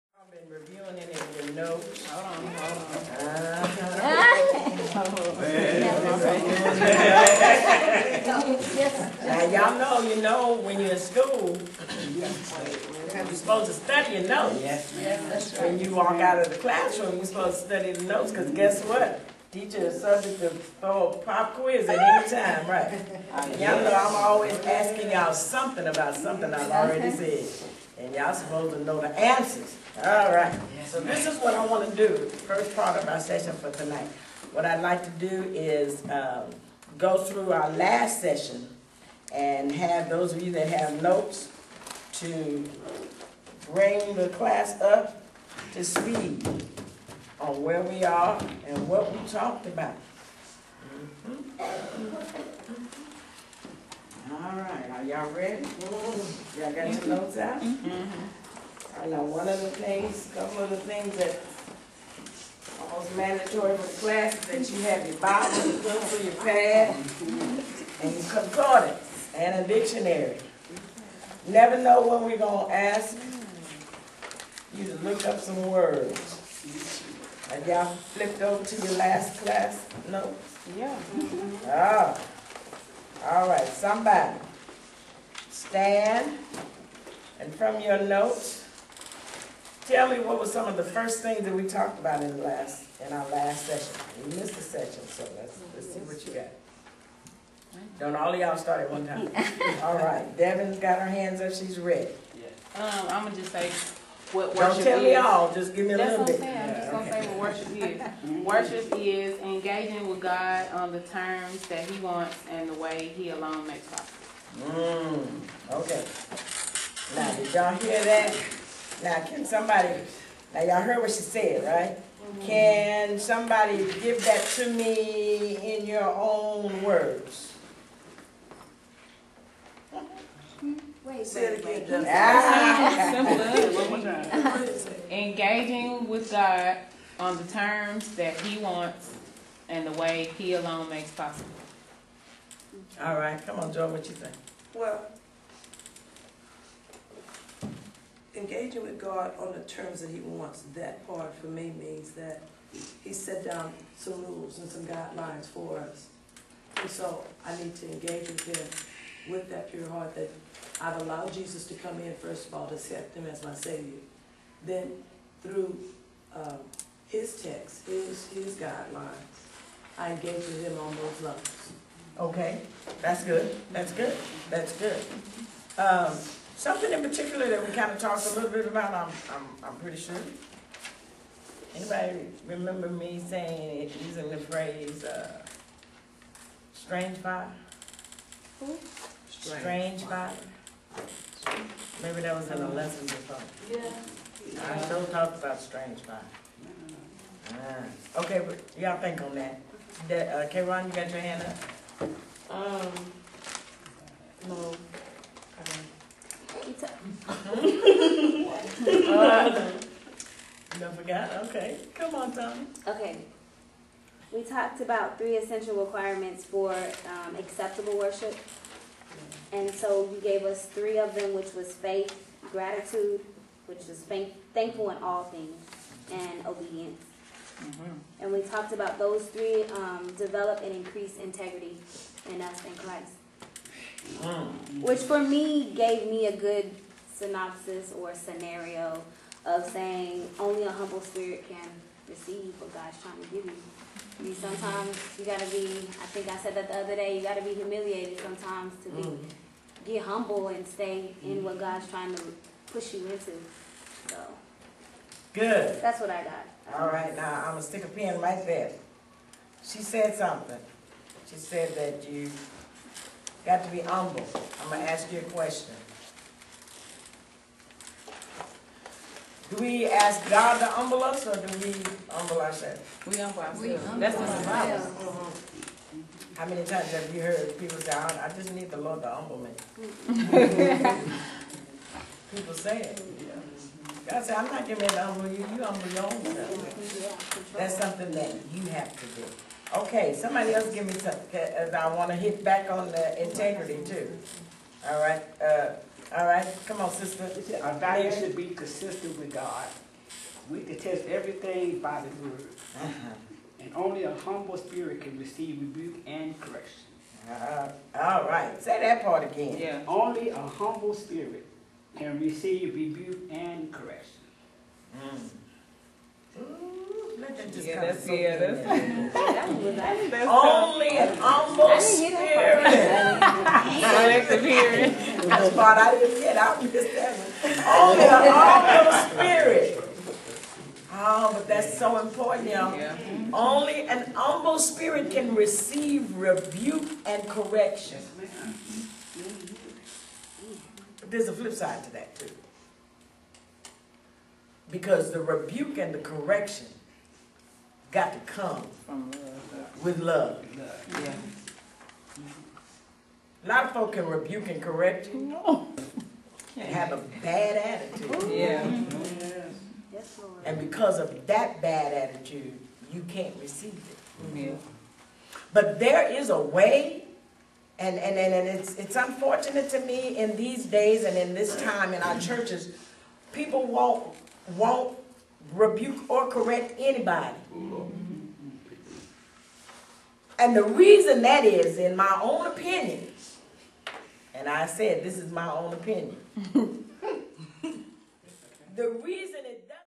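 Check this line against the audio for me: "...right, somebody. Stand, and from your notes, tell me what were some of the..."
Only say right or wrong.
right.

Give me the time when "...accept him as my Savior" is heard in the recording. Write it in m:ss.
2:42.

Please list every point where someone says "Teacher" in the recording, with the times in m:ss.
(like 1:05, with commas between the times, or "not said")
0:19.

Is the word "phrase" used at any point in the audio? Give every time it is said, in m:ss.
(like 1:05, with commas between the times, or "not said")
3:04.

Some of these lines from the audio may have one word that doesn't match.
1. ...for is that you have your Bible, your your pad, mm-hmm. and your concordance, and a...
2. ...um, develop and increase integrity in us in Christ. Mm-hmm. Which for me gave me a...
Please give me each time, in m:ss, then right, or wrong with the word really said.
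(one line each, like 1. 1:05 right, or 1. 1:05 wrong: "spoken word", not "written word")
1. 1:03 right
2. 3:49 right.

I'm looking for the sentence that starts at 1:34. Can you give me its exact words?
We missed the session, so let's, let's see what you got.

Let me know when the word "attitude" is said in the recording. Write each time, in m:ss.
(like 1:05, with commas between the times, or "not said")
5:57, 6:01.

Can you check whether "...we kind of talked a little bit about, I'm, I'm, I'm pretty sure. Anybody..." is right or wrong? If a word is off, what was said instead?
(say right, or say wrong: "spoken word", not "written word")
right.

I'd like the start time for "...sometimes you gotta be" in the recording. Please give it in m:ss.
4:04.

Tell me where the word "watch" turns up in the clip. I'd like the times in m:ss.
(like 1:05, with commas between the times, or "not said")
not said.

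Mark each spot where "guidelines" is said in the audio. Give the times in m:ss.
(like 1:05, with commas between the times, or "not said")
2:34, 2:48.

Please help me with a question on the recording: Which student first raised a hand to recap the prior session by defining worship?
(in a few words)
Devin.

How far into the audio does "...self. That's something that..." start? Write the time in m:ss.
4:46.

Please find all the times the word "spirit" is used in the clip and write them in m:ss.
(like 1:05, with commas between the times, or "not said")
4:01, 5:04, 5:10, 5:21, 5:29, 5:34.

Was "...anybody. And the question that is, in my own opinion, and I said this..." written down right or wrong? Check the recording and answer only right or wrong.
wrong.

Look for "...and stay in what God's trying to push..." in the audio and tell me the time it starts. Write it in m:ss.
4:10.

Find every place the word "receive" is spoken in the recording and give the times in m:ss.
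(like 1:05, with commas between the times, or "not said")
4:02, 5:05, 5:12, 5:35, 6:03.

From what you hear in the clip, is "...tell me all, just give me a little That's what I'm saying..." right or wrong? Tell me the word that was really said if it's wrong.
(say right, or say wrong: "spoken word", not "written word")
right.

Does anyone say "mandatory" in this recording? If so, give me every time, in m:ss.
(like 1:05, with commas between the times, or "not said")
1:03.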